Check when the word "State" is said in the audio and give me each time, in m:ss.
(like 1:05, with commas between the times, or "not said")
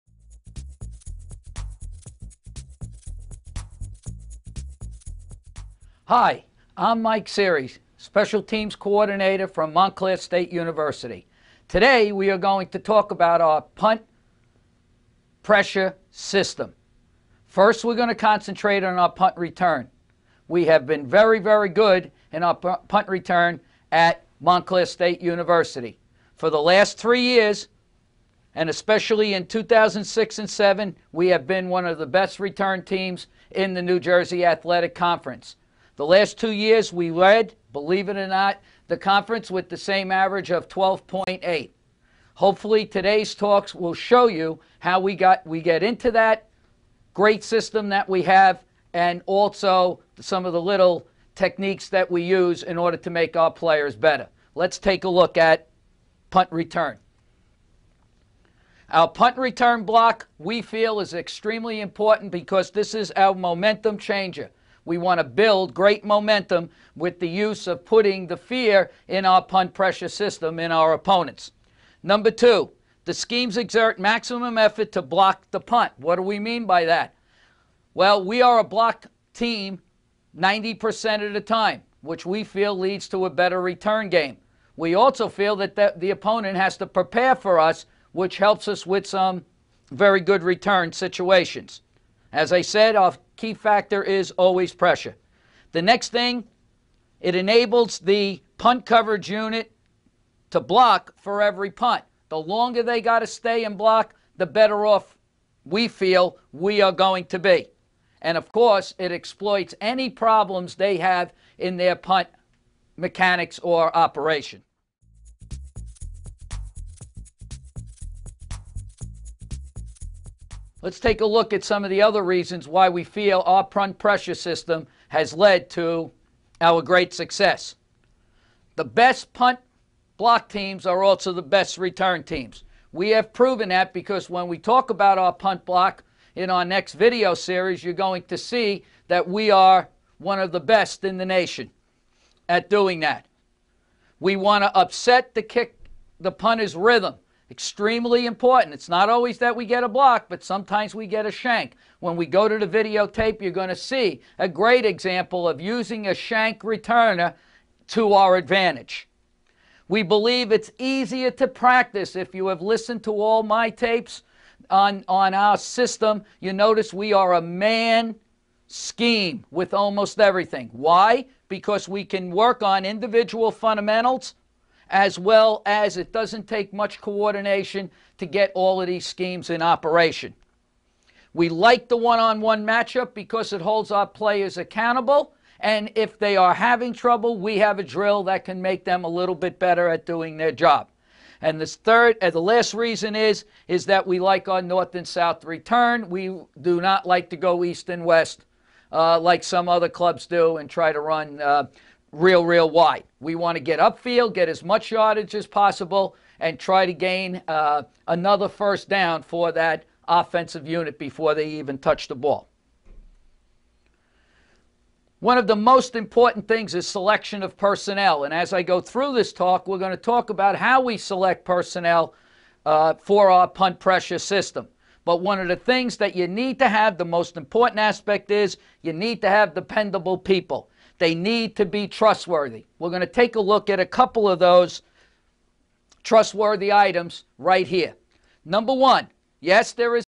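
0:10, 0:24.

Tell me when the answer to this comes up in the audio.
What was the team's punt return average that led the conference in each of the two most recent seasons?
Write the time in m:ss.
0:40.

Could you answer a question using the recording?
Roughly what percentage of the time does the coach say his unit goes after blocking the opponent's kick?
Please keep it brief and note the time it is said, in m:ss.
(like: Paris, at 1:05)
90%, at 1:20.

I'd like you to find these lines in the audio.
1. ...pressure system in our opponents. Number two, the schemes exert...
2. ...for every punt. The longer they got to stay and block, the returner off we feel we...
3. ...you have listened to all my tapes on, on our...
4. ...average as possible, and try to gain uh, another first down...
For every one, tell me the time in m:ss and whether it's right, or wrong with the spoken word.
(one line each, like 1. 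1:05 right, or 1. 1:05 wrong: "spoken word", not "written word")
1. 1:09 right
2. 1:41 wrong: "better", not "returner"
3. 2:42 right
4. 3:24 wrong: "yardage", not "average".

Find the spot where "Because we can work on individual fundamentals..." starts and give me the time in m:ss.
2:51.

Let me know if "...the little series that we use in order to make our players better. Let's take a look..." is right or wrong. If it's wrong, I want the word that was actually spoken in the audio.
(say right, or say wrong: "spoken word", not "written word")
wrong: "techniques", not "series".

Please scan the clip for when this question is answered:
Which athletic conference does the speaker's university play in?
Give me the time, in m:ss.
0:33.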